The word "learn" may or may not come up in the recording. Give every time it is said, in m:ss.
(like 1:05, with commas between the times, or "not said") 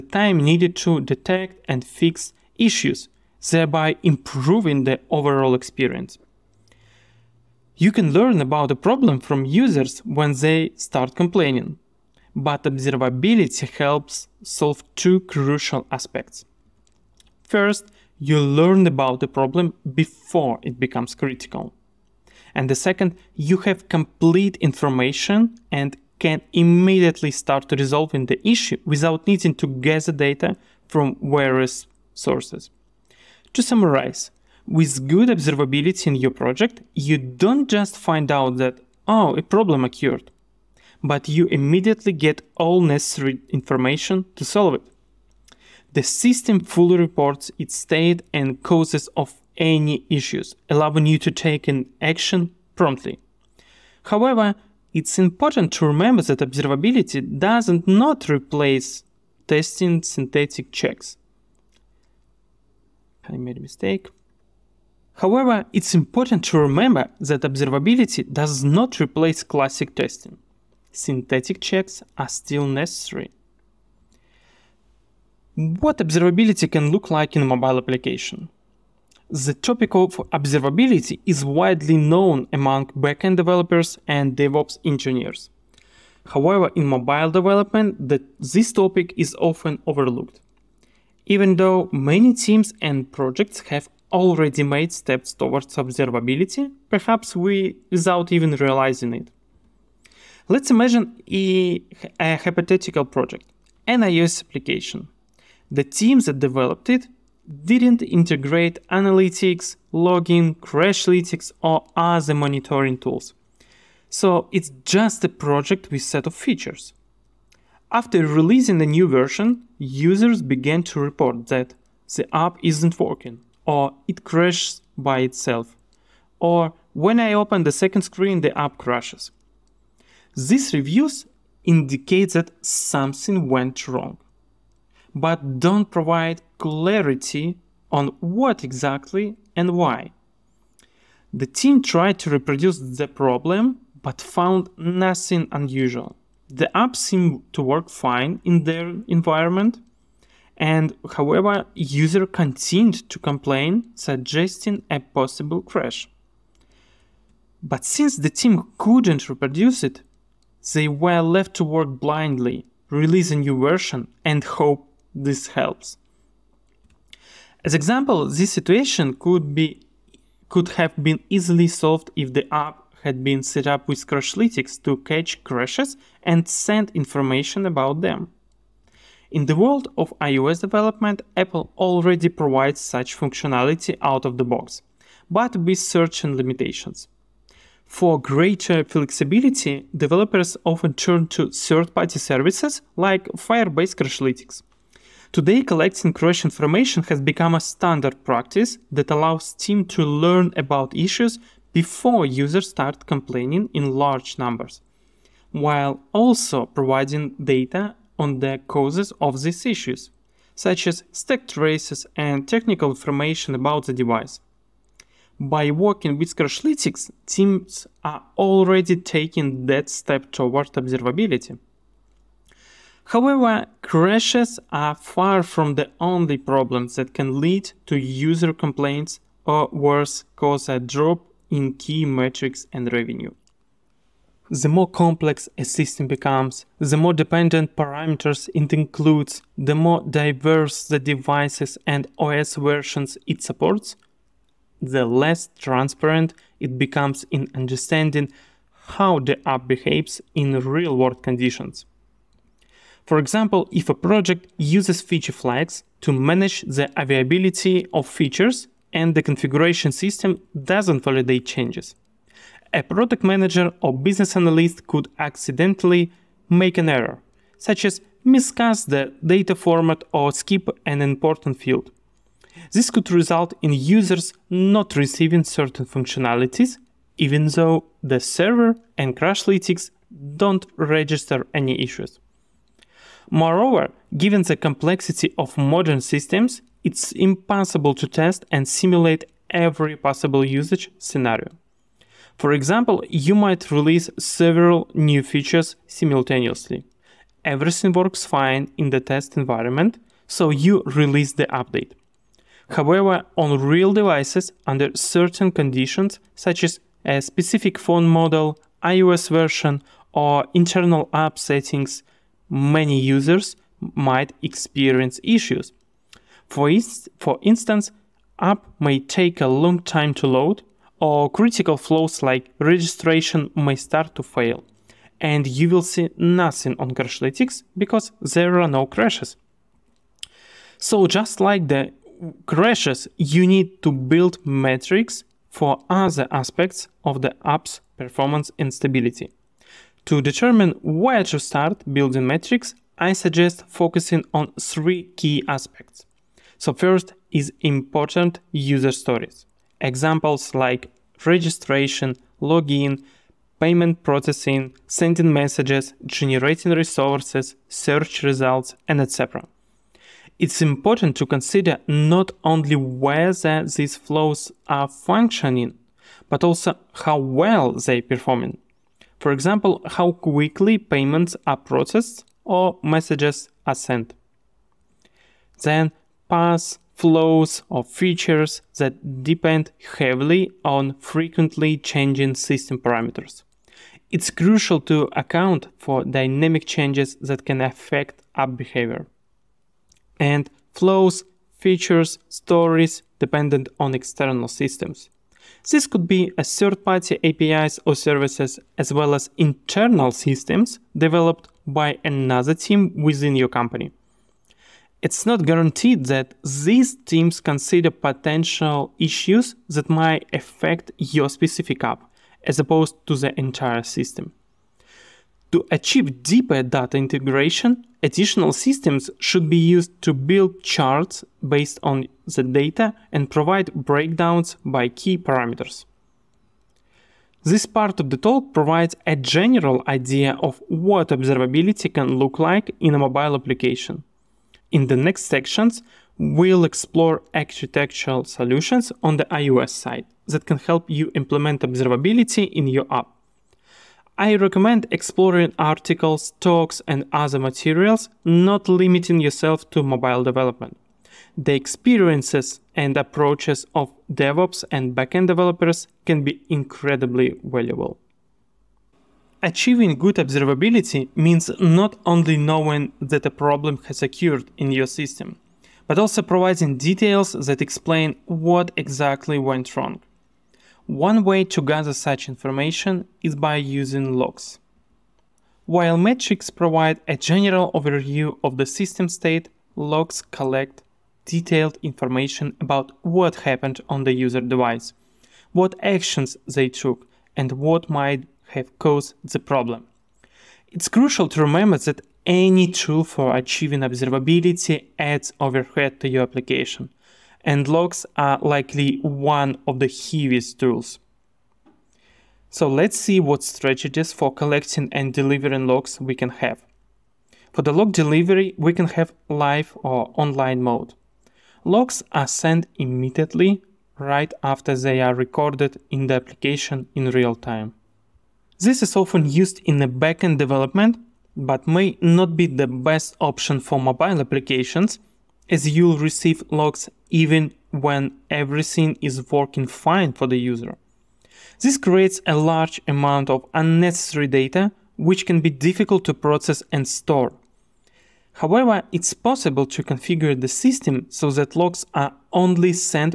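0:08, 0:18, 3:20.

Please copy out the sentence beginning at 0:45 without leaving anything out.
The system fully reports its state and causes of any issues, allowing you to take an action promptly.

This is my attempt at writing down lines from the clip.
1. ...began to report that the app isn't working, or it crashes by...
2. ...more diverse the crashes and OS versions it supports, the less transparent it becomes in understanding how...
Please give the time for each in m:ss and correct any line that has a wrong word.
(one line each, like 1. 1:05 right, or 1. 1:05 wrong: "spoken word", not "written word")
1. 2:00 right
2. 3:59 wrong: "devices", not "crashes".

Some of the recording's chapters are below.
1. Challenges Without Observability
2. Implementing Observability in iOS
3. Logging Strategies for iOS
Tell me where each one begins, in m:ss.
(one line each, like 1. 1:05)
1. 1:15
2. 3:35
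3. 7:50.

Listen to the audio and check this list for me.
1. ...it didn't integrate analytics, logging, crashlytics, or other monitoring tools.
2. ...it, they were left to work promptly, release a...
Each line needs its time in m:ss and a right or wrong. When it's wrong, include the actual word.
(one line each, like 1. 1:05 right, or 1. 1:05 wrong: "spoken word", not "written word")
1. 1:46 right
2. 2:39 wrong: "blindly", not "promptly".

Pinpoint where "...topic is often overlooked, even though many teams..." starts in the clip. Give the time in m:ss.
1:28.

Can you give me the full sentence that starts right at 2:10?
These reviews indicate that something went wrong, but don't provide clarity on what exactly and why.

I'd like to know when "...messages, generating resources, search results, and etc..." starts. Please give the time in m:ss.
5:55.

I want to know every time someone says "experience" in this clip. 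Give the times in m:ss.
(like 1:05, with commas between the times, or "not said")
0:05, 5:14, 7:31.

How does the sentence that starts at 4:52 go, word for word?
For example, you might release several new features simultaneously.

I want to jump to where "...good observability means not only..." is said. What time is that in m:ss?
7:39.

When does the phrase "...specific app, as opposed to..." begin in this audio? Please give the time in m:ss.
6:51.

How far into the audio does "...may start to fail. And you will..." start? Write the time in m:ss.
5:23.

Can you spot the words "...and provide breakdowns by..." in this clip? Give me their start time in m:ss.
7:03.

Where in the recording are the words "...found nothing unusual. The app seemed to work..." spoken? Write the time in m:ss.
2:24.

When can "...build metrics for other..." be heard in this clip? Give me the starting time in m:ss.
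5:33.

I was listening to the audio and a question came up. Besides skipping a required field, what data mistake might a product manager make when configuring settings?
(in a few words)
Miscast the data format.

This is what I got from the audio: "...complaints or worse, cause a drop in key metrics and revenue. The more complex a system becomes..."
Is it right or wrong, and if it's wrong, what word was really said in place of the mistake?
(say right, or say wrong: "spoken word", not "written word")
right.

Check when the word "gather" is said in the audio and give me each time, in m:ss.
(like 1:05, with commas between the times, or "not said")
0:29, 7:51.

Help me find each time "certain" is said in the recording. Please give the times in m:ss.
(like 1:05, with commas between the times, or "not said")
3:05, 4:35, 5:04.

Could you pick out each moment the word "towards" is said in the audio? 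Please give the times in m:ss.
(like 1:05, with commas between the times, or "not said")
1:35, 3:40.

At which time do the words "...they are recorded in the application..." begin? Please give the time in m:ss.
8:34.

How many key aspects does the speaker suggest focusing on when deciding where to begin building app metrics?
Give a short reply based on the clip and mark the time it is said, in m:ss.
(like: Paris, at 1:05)
3, at 5:44.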